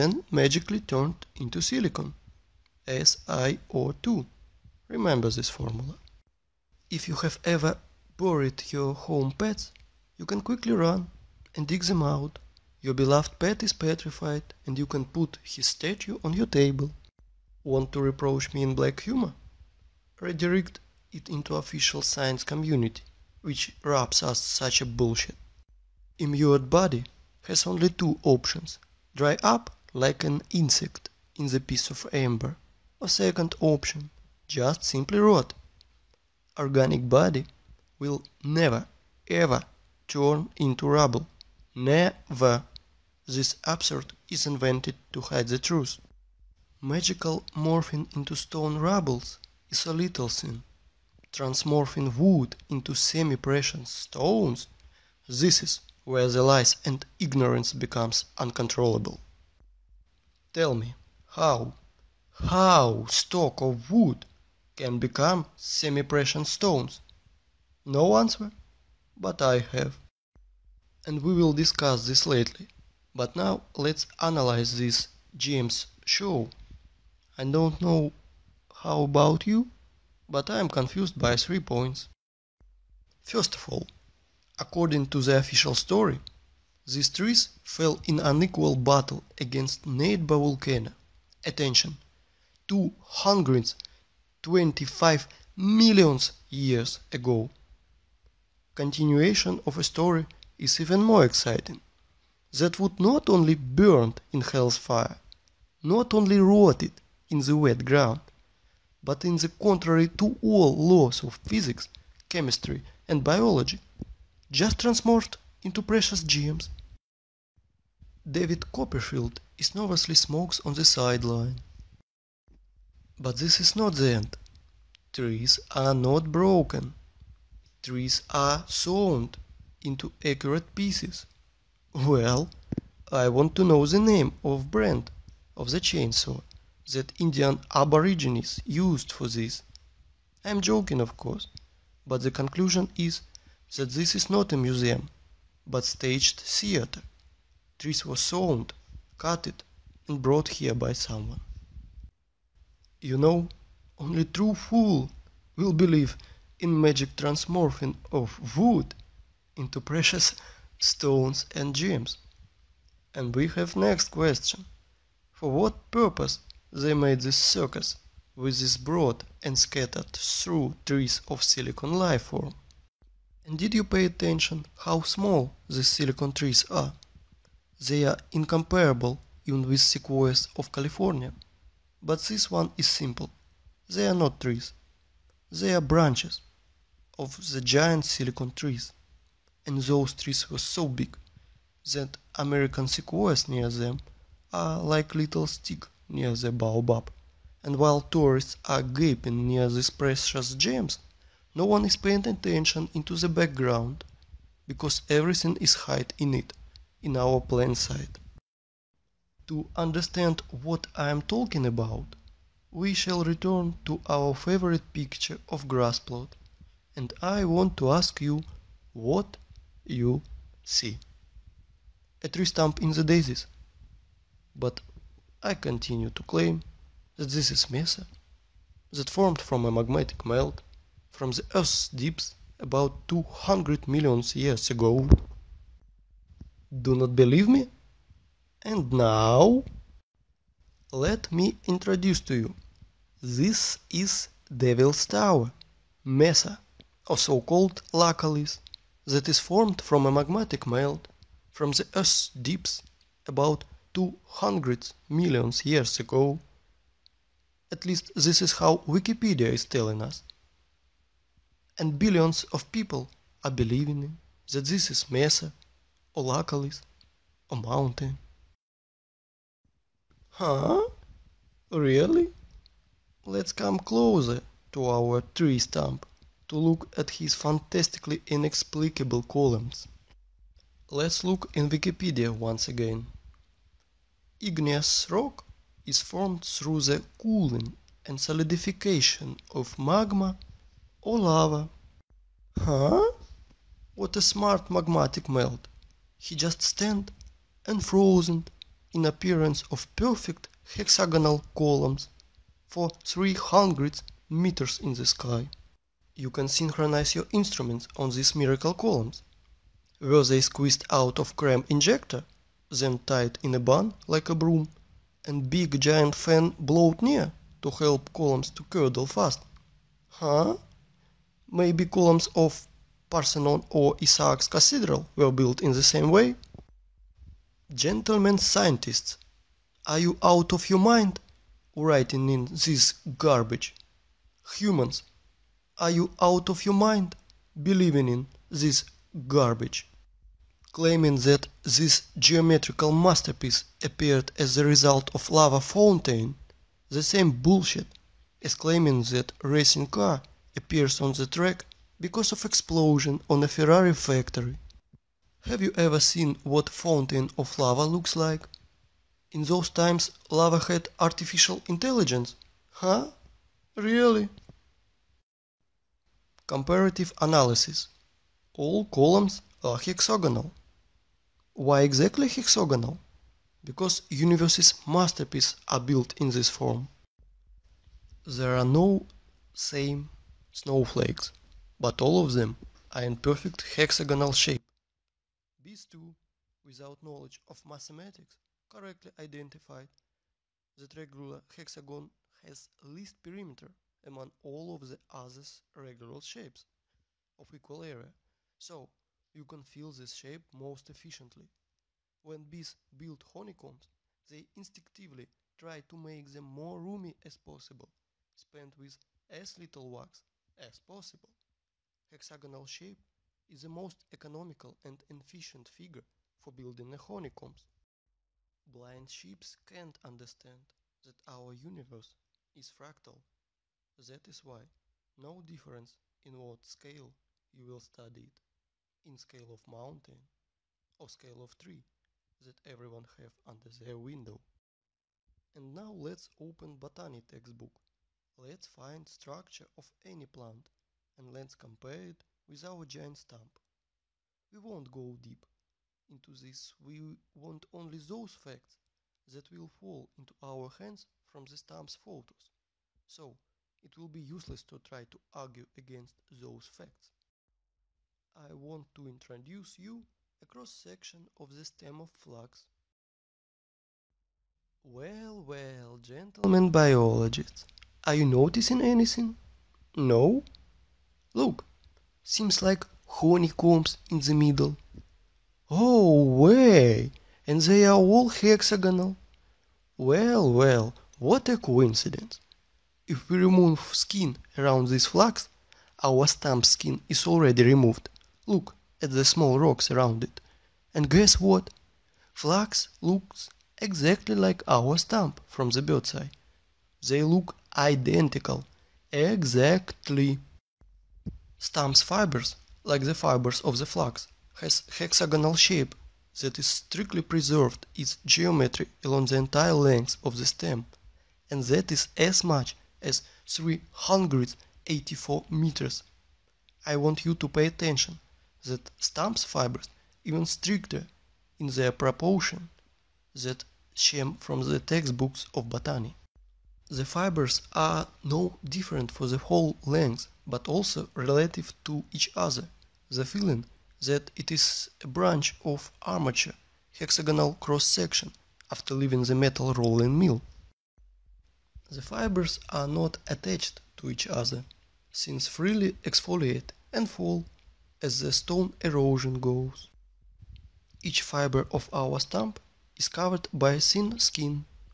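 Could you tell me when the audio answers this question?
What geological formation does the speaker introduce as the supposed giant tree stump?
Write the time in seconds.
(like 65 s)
244 s.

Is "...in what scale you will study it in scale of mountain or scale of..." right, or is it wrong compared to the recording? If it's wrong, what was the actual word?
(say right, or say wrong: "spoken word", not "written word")
right.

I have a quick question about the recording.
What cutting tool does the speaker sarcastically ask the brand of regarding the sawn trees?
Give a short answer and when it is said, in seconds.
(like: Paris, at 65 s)
Chainsaw, at 135 s.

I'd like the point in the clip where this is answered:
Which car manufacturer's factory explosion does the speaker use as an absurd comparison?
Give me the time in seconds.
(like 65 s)
353 s.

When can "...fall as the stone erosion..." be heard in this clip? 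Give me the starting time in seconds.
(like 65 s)
547 s.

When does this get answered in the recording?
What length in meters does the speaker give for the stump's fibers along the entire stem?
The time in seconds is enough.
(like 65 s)
513 s.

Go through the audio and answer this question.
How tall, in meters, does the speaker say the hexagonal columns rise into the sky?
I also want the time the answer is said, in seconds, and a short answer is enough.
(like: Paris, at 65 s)
300 meters, at 303 s.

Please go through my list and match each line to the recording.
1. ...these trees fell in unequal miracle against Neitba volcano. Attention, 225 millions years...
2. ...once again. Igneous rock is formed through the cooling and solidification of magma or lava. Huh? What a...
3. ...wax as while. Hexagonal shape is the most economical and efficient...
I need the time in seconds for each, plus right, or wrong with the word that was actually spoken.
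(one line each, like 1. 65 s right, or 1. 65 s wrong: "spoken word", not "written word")
1. 86 s wrong: "battle", not "miracle"
2. 282 s right
3. 409 s wrong: "possible", not "while".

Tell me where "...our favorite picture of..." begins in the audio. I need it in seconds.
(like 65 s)
214 s.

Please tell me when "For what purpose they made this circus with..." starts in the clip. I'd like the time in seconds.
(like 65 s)
165 s.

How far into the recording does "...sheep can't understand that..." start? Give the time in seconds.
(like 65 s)
419 s.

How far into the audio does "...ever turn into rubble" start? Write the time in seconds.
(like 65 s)
39 s.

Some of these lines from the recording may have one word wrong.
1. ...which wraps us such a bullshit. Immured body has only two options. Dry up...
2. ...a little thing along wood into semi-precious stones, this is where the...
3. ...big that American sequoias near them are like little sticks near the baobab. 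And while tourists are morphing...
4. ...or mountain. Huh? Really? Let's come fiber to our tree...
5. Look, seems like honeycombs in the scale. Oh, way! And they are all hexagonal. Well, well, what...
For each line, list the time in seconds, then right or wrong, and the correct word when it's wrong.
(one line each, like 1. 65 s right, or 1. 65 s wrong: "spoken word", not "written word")
1. 23 s right
2. 49 s wrong: "transmorphing", not "along"
3. 190 s wrong: "gaping", not "morphing"
4. 267 s wrong: "closer", not "fiber"
5. 471 s wrong: "middle", not "scale".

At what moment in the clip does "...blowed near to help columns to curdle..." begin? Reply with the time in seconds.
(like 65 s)
316 s.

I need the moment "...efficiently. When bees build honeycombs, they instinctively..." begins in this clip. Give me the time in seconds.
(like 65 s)
400 s.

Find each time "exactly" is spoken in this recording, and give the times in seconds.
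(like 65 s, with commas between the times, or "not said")
371 s, 493 s, 499 s.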